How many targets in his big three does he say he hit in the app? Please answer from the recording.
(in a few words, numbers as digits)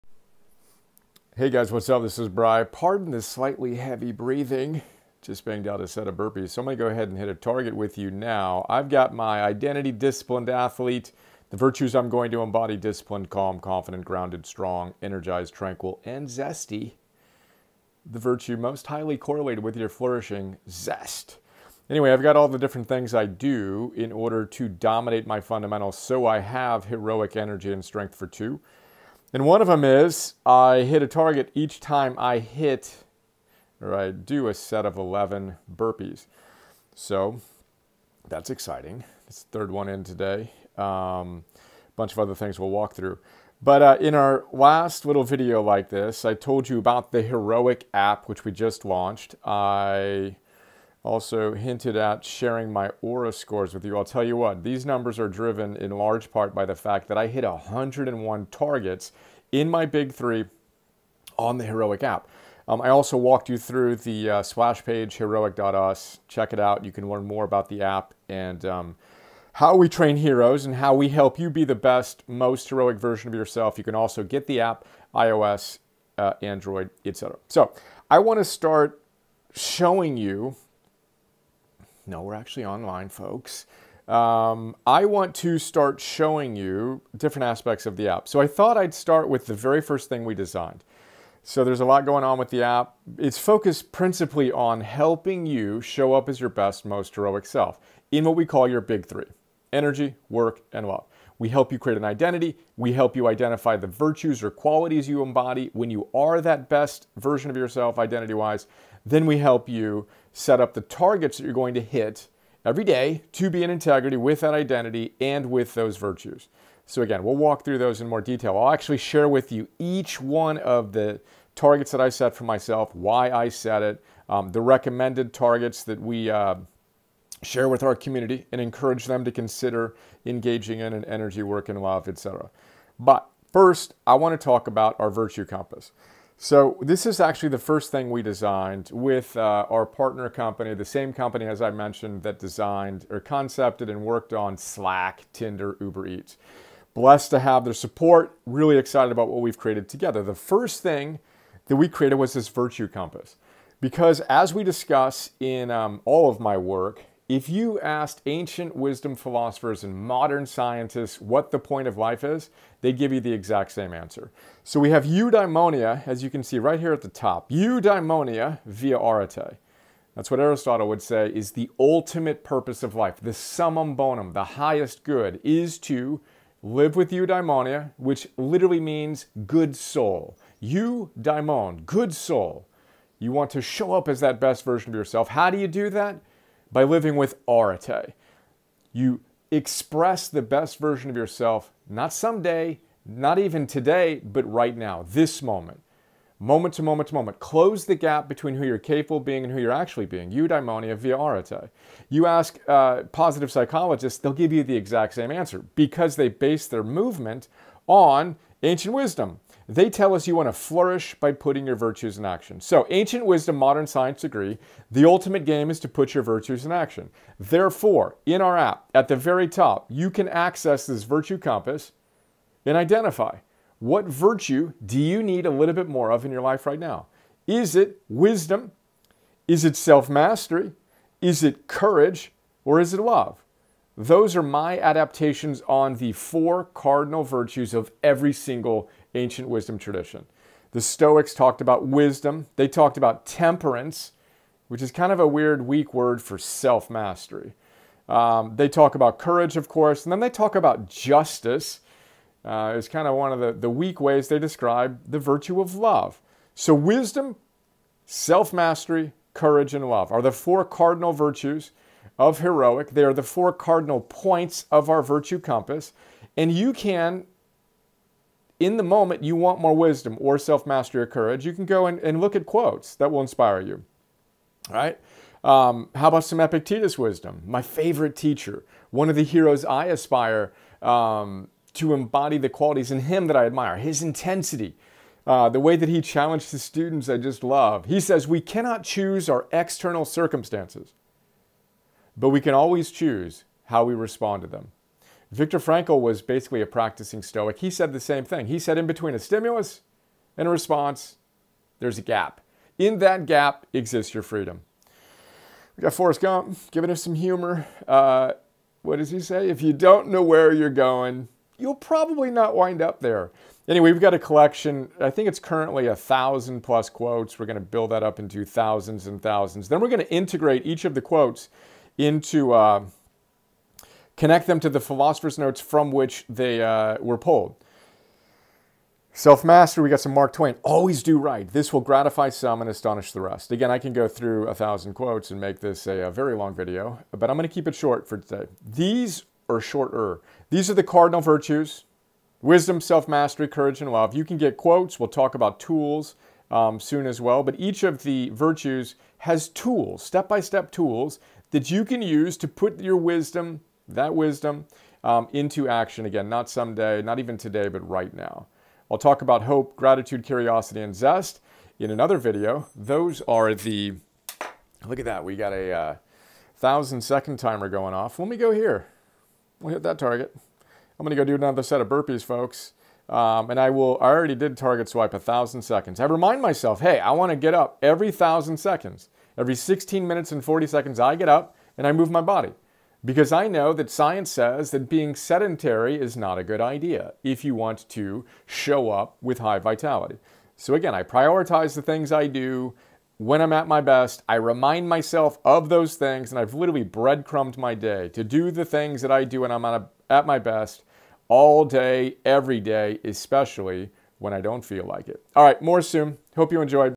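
101.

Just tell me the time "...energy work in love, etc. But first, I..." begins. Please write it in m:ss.
2:11.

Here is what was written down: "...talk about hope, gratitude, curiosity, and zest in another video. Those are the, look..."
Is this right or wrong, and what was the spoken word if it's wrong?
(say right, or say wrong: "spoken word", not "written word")
right.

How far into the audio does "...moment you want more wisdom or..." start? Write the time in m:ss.
4:28.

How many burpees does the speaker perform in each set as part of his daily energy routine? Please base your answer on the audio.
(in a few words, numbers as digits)
11.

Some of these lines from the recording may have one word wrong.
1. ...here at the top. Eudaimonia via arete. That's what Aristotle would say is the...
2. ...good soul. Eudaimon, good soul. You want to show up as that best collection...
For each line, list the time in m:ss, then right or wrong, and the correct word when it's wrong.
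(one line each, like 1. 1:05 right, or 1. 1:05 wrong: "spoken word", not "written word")
1. 2:46 right
2. 2:59 wrong: "version", not "collection".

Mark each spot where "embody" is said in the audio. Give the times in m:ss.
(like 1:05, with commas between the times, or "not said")
0:12, 1:45, 4:41.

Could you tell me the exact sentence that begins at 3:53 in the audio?
Those are my adaptations on the four cardinal virtues of every single ancient wisdom tradition.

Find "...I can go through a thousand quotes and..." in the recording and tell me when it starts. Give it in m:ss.
5:33.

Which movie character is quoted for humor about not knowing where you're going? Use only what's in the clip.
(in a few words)
Forrest Gump.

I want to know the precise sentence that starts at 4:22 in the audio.
They are the four cardinal points of our virtue compass.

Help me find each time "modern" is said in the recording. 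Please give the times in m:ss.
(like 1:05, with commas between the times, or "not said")
2:39, 3:33.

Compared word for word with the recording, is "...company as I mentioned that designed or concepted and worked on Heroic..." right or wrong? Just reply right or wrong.
wrong.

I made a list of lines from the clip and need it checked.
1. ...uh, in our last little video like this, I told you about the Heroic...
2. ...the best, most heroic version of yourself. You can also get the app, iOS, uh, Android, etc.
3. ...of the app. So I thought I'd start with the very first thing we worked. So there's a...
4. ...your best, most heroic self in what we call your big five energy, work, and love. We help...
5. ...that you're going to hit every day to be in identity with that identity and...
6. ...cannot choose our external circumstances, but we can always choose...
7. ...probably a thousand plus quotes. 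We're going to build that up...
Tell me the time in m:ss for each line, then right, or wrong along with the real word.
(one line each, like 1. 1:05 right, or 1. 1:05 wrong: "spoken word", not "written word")
1. 0:43 right
2. 1:11 right
3. 1:27 wrong: "designed", not "worked"
4. 1:36 wrong: "three", not "five"
5. 1:51 wrong: "integrity", not "identity"
6. 4:48 right
7. 5:15 wrong: "currently", not "probably".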